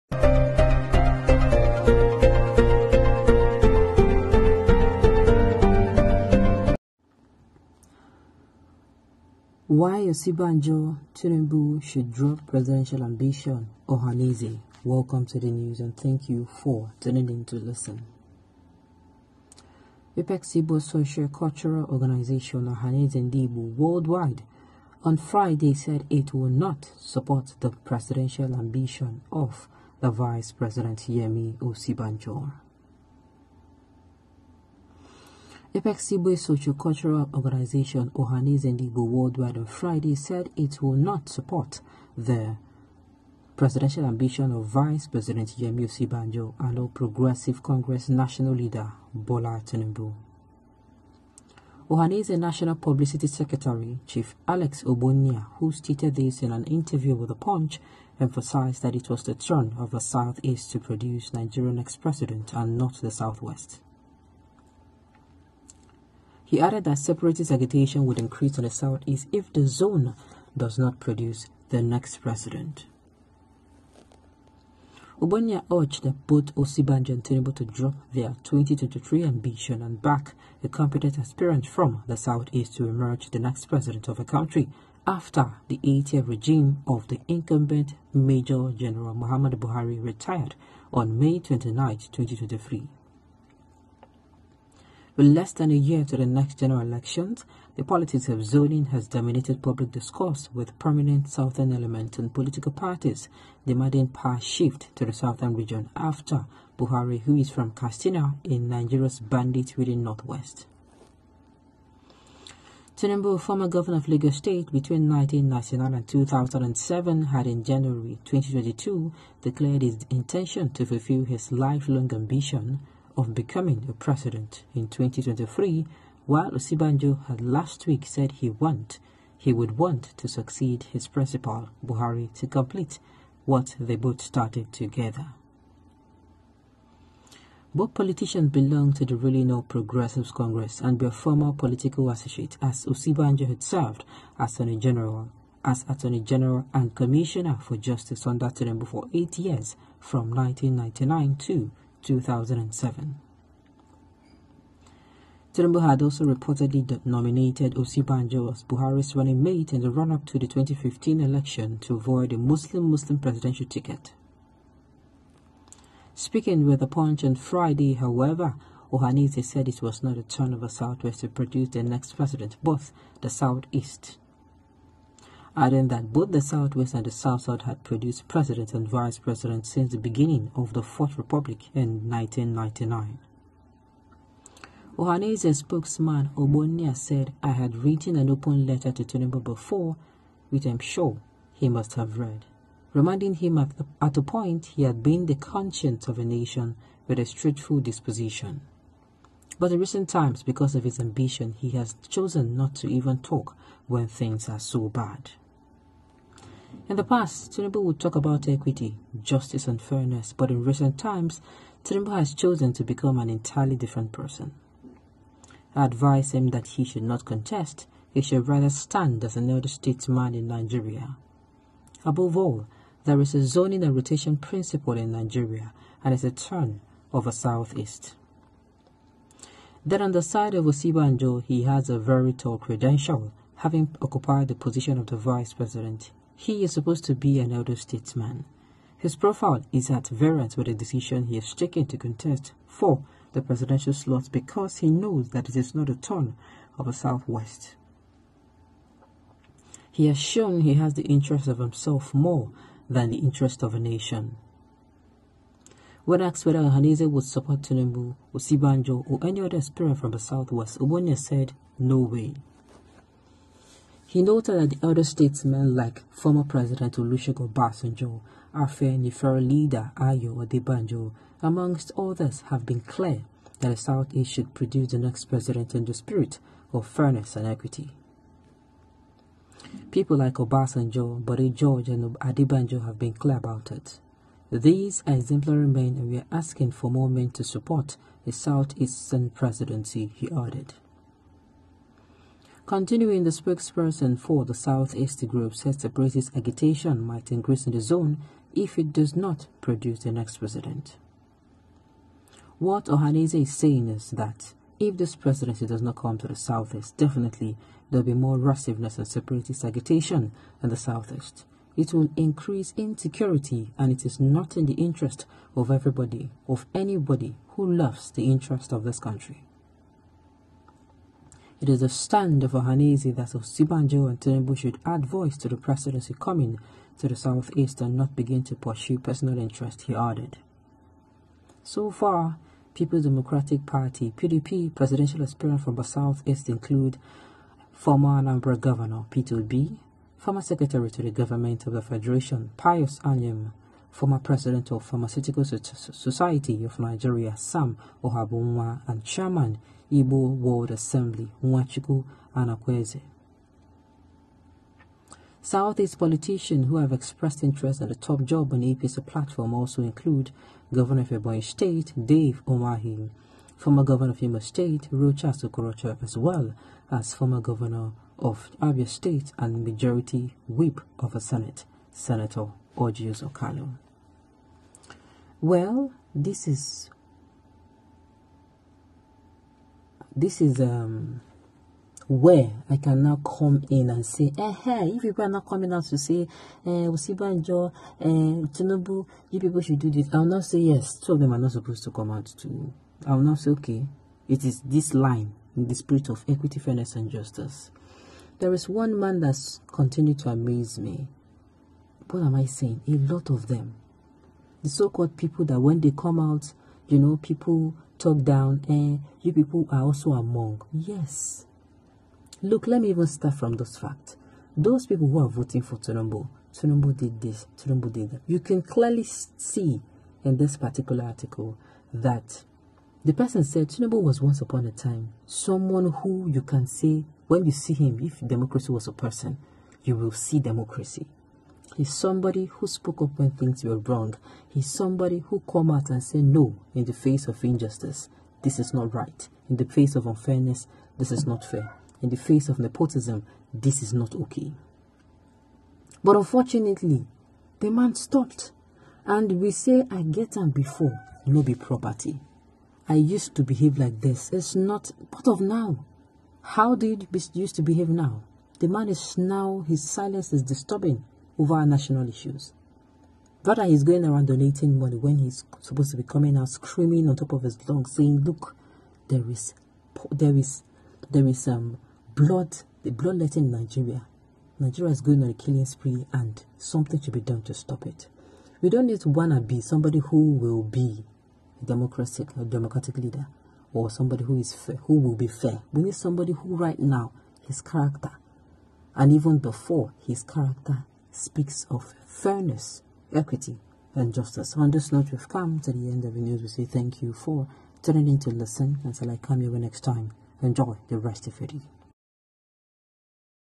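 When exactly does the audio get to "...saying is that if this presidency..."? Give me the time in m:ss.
5:03.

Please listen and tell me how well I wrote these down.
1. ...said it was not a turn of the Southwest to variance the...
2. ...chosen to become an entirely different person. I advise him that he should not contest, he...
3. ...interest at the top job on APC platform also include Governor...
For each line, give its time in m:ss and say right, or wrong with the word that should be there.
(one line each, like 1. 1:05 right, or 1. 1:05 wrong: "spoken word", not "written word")
1. 2:49 wrong: "produce", not "variance"
2. 3:32 right
3. 5:57 right.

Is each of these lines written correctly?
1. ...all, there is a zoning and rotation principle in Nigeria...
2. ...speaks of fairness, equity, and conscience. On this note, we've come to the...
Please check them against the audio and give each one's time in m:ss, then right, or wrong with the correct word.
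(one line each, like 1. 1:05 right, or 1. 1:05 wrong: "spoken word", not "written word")
1. 3:42 right
2. 8:11 wrong: "justice", not "conscience".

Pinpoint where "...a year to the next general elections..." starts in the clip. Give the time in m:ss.
1:35.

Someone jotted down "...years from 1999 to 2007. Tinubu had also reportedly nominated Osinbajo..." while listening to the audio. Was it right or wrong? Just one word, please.
right.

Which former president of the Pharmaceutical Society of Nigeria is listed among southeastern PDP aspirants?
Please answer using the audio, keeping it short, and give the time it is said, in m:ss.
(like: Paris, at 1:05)
Sam Ohabunwa, at 5:47.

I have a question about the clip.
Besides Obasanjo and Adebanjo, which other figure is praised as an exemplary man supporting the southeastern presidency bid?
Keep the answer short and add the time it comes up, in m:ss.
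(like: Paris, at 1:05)
Bode George, at 4:41.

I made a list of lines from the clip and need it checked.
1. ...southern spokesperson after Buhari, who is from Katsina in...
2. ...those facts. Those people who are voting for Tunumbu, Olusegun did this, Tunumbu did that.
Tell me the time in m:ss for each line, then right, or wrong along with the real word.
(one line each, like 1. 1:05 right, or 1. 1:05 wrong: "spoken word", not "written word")
1. 1:45 wrong: "region", not "spokesperson"
2. 6:53 wrong: "Tunumbu", not "Olusegun".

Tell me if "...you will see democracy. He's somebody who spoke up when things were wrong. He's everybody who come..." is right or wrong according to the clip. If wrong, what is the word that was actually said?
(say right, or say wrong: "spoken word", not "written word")
wrong: "somebody", not "everybody".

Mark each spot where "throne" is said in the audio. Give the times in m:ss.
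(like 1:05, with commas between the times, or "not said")
not said.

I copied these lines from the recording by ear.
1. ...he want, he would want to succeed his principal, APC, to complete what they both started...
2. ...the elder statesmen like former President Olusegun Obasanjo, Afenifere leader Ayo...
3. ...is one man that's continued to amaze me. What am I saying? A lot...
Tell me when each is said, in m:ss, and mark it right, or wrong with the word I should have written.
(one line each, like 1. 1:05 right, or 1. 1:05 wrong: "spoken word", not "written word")
1. 2:08 wrong: "Buhari", not "APC"
2. 4:24 right
3. 6:38 right.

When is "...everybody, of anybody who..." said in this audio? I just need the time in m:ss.
5:15.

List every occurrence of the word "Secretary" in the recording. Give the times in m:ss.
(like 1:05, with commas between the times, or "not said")
0:53, 5:40.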